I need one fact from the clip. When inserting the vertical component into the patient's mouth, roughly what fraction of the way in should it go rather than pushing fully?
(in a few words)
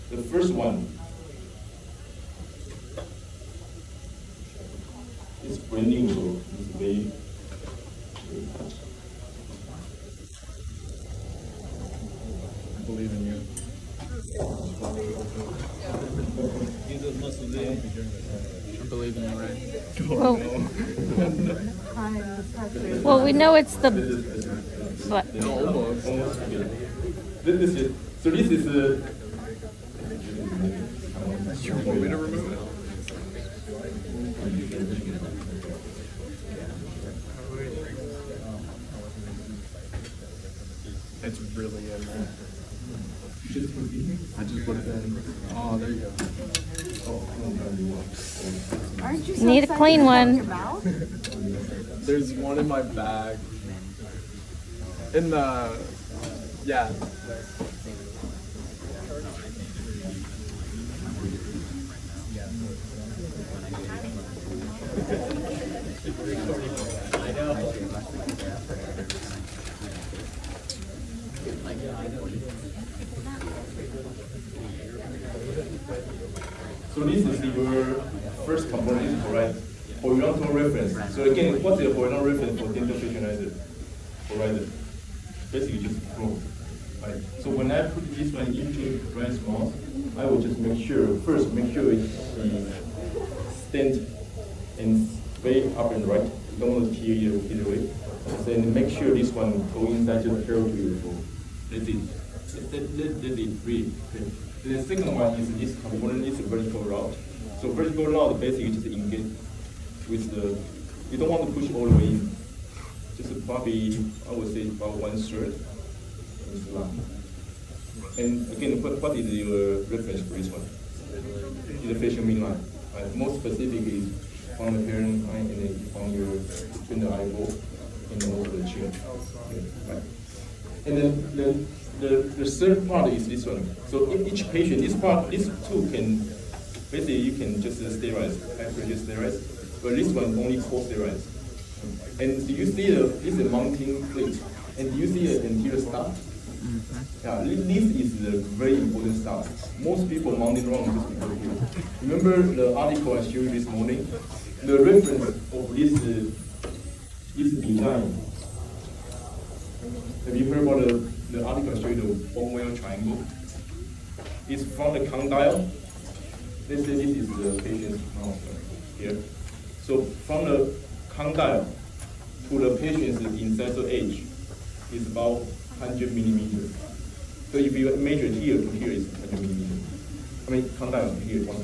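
one third.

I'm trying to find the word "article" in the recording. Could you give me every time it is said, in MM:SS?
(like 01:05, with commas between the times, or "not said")
02:32, 02:41.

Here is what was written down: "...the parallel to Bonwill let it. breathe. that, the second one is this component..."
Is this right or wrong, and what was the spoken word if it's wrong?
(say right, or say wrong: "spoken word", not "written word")
wrong: "Then", not "Bonwill".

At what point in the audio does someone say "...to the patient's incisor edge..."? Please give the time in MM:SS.
02:52.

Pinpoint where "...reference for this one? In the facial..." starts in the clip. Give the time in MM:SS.
01:59.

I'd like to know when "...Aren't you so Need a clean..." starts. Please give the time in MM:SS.
00:49.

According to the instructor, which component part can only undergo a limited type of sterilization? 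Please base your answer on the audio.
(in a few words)
anterior star.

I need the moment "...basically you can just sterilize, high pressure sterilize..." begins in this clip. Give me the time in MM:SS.
02:16.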